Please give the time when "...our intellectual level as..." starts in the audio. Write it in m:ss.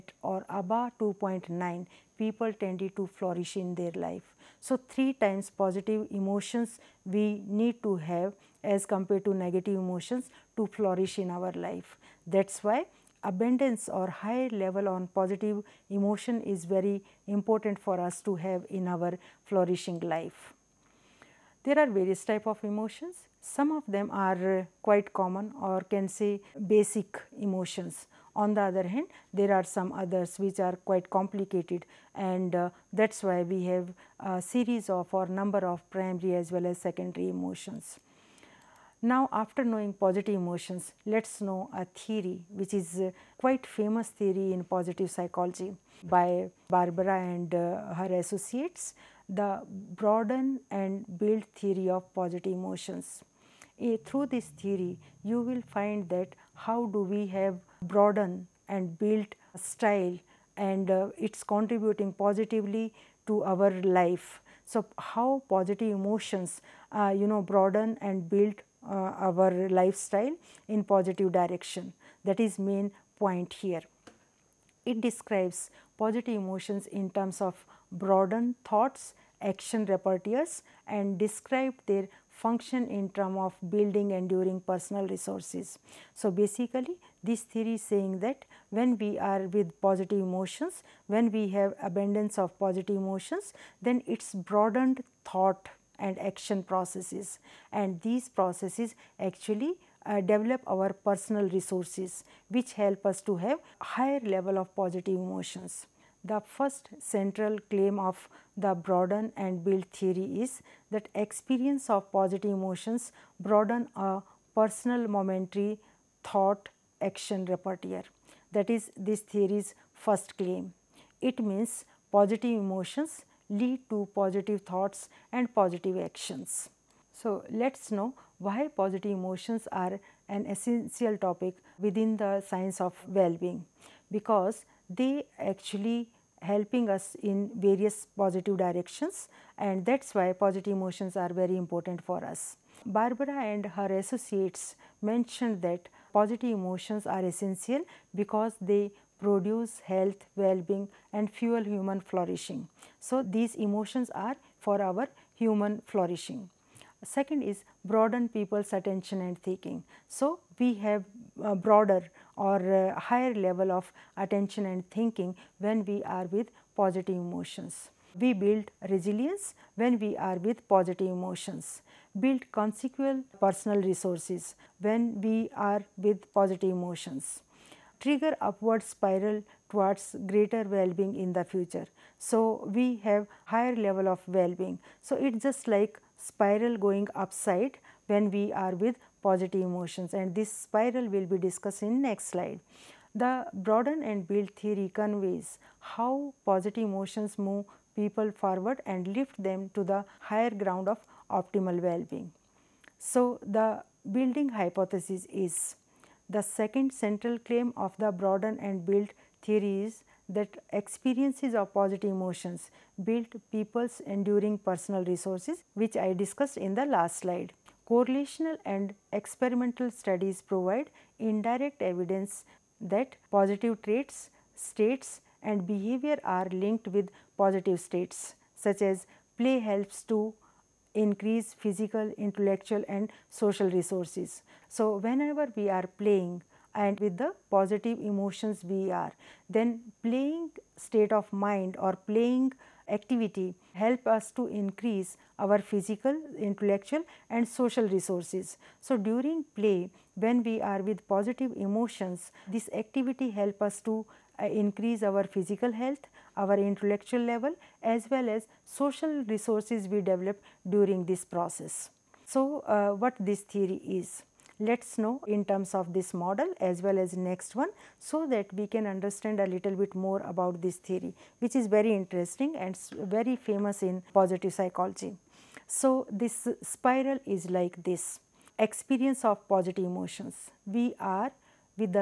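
4:16.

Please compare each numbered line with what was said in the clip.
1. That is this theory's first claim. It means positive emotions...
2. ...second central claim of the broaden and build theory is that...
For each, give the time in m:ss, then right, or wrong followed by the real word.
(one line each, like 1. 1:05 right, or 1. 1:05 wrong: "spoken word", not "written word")
1. 1:58 right
2. 3:26 right.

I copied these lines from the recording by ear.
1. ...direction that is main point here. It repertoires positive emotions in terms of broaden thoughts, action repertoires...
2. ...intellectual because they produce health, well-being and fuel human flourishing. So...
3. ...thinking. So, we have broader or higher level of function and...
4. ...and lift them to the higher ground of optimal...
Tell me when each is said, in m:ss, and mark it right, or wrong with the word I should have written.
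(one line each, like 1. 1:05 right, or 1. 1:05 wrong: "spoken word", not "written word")
1. 1:11 wrong: "describes", not "repertoires"
2. 2:27 wrong: "essential", not "intellectual"
3. 2:39 wrong: "attention", not "function"
4. 3:18 right.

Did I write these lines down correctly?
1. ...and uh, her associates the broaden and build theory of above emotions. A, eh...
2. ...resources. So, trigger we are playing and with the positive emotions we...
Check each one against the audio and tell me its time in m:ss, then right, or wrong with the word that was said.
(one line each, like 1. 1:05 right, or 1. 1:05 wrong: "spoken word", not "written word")
1. 0:47 wrong: "positive", not "above"
2. 3:53 wrong: "whenever", not "trigger".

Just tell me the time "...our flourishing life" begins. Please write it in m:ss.
0:18.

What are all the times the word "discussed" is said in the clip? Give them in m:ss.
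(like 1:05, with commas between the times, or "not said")
3:11, 3:36.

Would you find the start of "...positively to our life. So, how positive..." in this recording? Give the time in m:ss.
1:02.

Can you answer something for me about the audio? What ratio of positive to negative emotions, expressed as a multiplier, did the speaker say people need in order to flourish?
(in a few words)
3 times.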